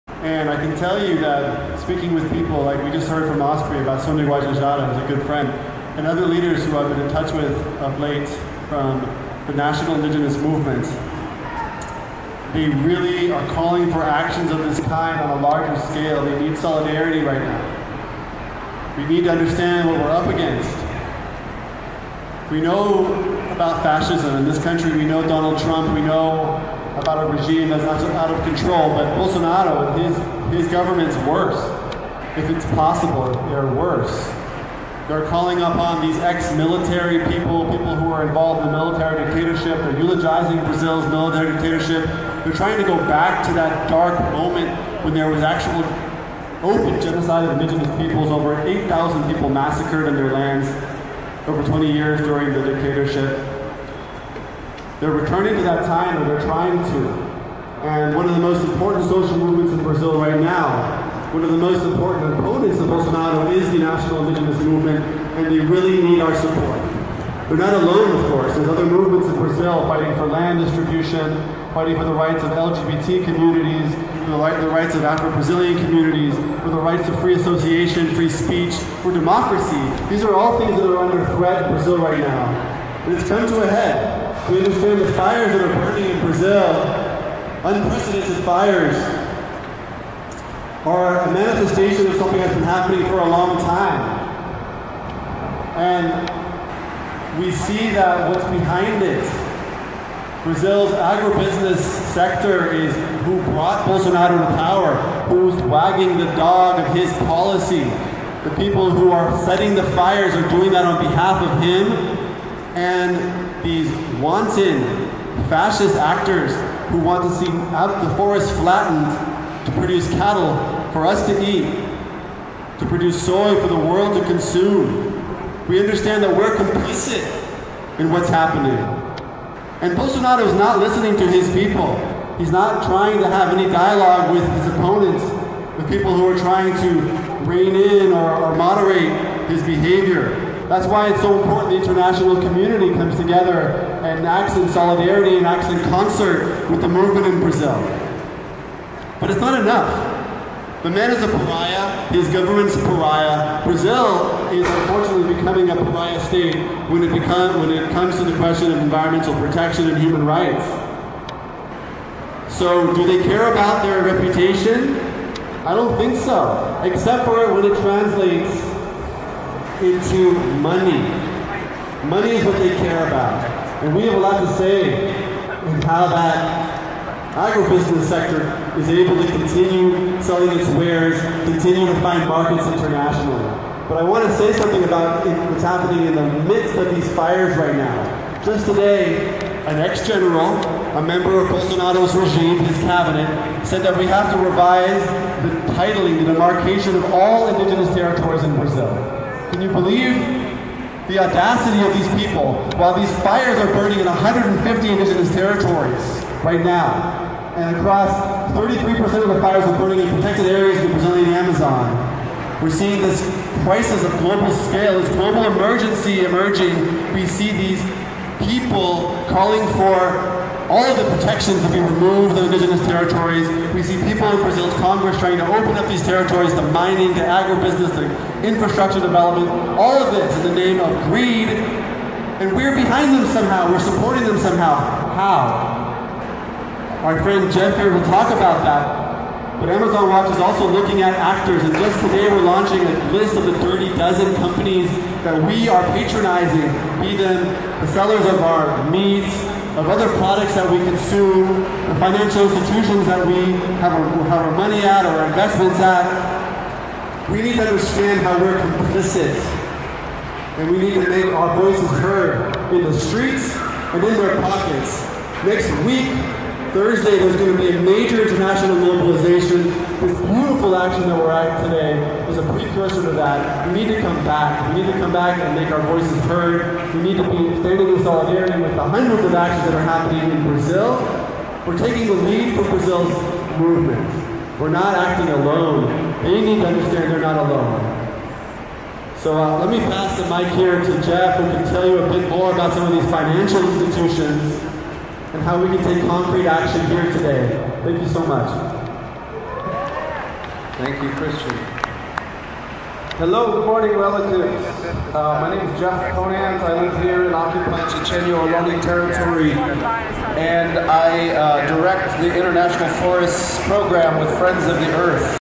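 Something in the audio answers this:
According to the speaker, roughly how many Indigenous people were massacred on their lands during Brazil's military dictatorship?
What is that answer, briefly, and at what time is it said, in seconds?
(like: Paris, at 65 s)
over 8,000, at 48 s.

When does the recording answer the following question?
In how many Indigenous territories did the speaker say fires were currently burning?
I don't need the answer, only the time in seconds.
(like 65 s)
204 s.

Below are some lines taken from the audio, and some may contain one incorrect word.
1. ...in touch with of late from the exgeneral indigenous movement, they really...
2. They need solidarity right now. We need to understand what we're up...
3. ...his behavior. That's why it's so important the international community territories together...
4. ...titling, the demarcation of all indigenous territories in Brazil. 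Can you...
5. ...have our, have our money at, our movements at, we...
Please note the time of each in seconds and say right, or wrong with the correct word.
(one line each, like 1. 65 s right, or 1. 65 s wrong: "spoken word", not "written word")
1. 7 s wrong: "national", not "exgeneral"
2. 16 s right
3. 139 s wrong: "comes", not "territories"
4. 195 s right
5. 253 s wrong: "investments", not "movements".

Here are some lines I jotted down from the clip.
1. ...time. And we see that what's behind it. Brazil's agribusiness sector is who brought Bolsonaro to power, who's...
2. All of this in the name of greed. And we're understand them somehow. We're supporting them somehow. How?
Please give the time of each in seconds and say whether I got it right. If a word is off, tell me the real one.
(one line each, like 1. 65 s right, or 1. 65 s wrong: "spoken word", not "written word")
1. 93 s right
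2. 229 s wrong: "behind", not "understand".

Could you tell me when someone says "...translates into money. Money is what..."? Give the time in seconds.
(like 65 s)
167 s.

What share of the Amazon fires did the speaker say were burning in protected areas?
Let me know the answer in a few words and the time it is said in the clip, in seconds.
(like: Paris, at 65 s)
33%, at 208 s.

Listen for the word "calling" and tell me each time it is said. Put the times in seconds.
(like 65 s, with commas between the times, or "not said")
13 s, 35 s, 219 s.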